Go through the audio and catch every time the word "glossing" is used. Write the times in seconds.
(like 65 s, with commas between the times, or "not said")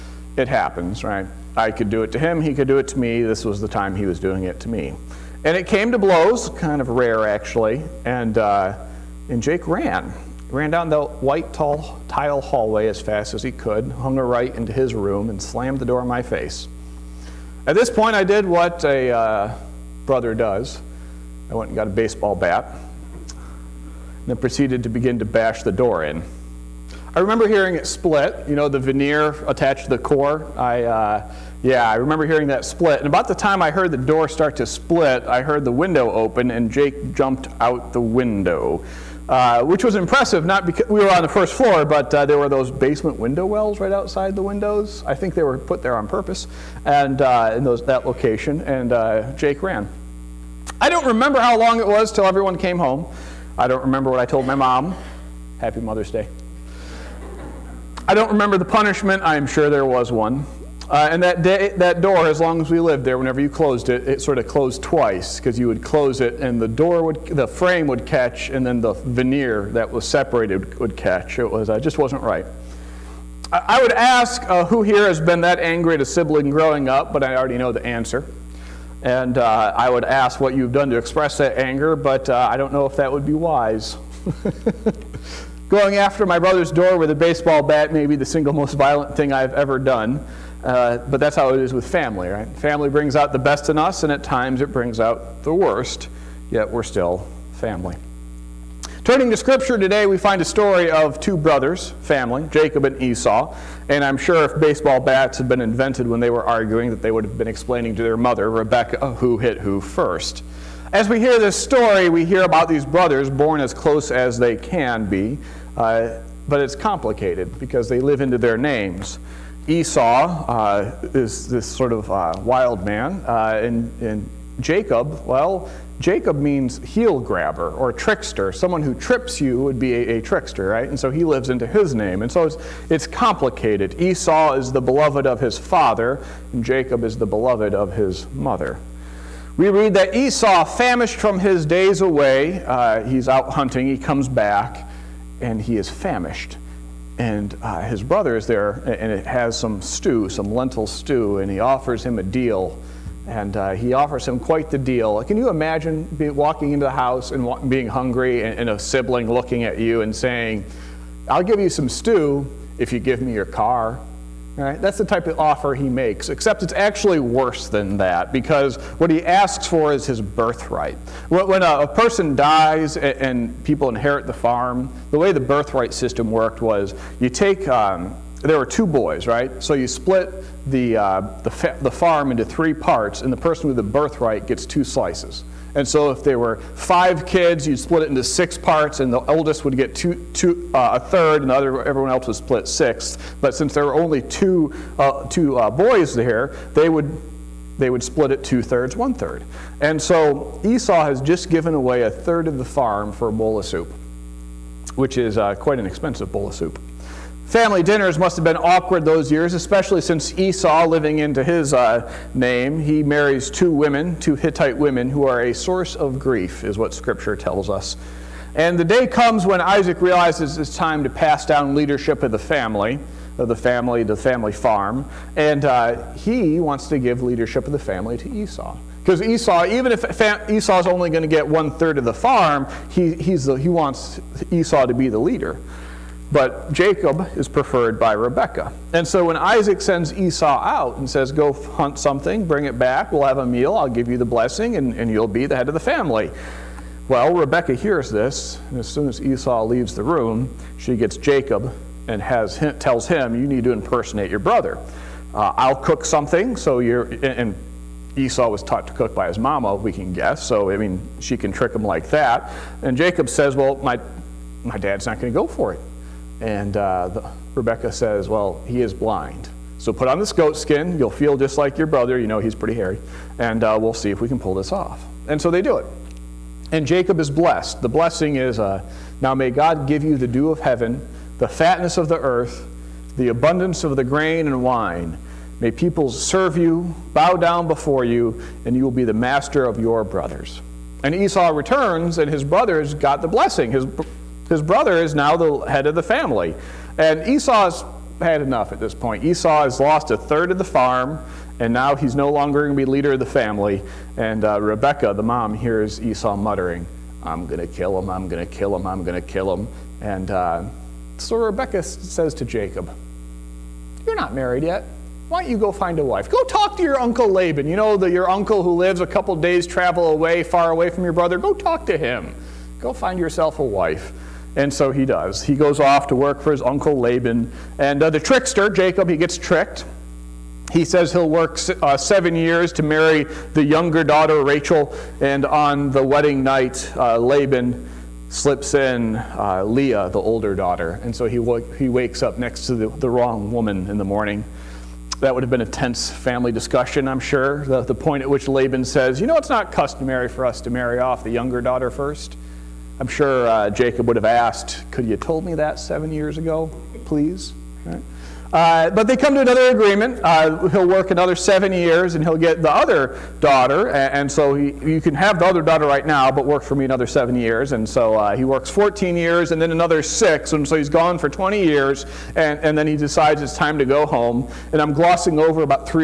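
374 s.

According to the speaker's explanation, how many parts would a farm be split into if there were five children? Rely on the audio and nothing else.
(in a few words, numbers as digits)
6.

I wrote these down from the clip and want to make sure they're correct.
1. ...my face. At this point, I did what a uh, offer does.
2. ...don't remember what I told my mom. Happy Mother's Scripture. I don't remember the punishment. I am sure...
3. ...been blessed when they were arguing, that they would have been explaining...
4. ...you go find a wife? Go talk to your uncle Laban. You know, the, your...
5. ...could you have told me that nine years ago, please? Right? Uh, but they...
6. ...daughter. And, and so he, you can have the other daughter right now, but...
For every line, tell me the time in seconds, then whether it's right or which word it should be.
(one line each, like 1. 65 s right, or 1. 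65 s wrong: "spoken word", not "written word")
1. 16 s wrong: "brother", not "offer"
2. 53 s wrong: "Day", not "Scripture"
3. 105 s wrong: "invented", not "blessed"
4. 315 s right
5. 354 s wrong: "seven", not "nine"
6. 363 s right.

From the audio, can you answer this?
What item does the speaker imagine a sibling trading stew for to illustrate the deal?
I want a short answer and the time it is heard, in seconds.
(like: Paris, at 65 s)
Car, at 163 s.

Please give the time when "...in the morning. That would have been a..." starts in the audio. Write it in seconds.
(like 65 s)
343 s.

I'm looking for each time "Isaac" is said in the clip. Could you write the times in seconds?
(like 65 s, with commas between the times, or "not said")
219 s, 239 s.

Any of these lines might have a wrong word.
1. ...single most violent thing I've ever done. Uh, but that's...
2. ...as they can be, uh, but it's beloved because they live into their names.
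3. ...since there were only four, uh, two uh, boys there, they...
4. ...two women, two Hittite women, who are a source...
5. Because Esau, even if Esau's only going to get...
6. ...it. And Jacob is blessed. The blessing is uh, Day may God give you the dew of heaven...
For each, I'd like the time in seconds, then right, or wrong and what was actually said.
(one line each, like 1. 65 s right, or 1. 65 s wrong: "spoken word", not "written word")
1. 88 s right
2. 114 s wrong: "complicated", not "beloved"
3. 193 s wrong: "two", not "four"
4. 213 s right
5. 229 s right
6. 275 s wrong: "Now", not "Day".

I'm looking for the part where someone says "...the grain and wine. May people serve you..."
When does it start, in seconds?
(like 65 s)
283 s.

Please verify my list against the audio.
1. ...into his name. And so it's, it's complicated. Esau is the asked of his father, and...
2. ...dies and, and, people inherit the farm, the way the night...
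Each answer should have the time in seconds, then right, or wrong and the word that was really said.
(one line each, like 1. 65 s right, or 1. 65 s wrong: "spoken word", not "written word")
1. 131 s wrong: "beloved", not "asked"
2. 172 s wrong: "birthright", not "night".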